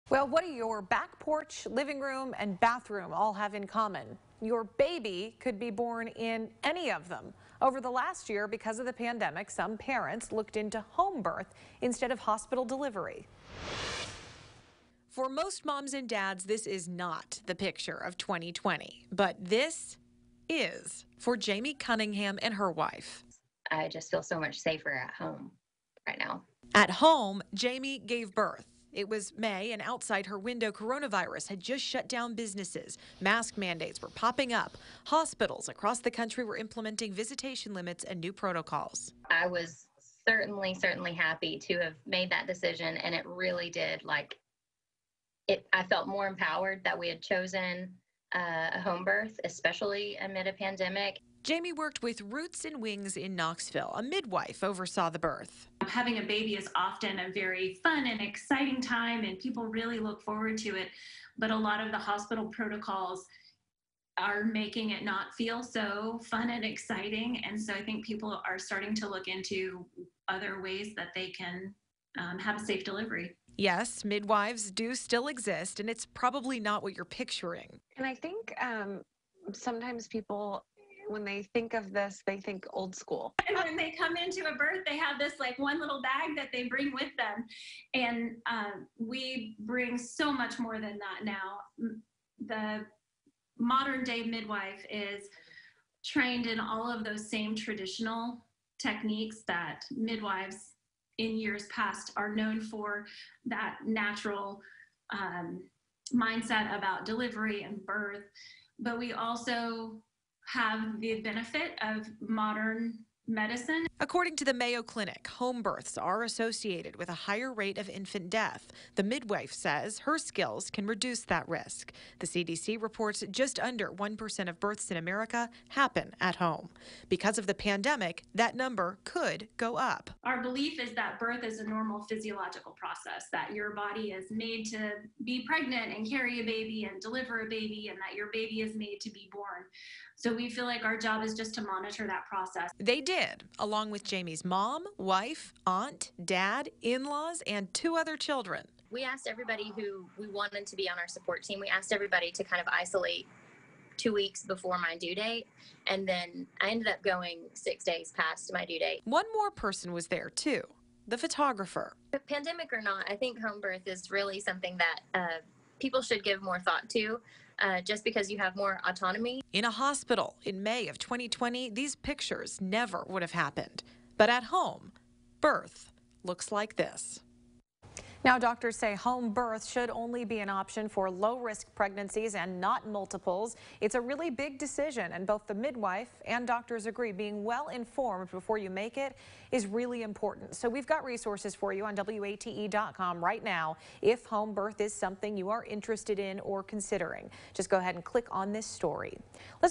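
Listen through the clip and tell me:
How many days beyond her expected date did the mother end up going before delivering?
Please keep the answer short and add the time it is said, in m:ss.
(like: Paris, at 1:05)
6, at 2:37.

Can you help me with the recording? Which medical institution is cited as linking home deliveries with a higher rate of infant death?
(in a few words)
Mayo Clinic.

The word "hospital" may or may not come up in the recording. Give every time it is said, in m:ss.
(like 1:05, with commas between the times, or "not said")
0:12, 0:35, 1:01, 2:49.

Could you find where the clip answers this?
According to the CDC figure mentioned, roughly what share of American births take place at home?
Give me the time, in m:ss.
2:03.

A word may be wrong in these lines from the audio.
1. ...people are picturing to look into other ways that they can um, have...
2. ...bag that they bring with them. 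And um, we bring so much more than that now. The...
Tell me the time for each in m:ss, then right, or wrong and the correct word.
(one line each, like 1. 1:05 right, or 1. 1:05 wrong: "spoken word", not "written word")
1. 1:08 wrong: "starting", not "picturing"
2. 1:26 right.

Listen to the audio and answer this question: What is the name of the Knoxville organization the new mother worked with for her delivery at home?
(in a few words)
Roots and Wings.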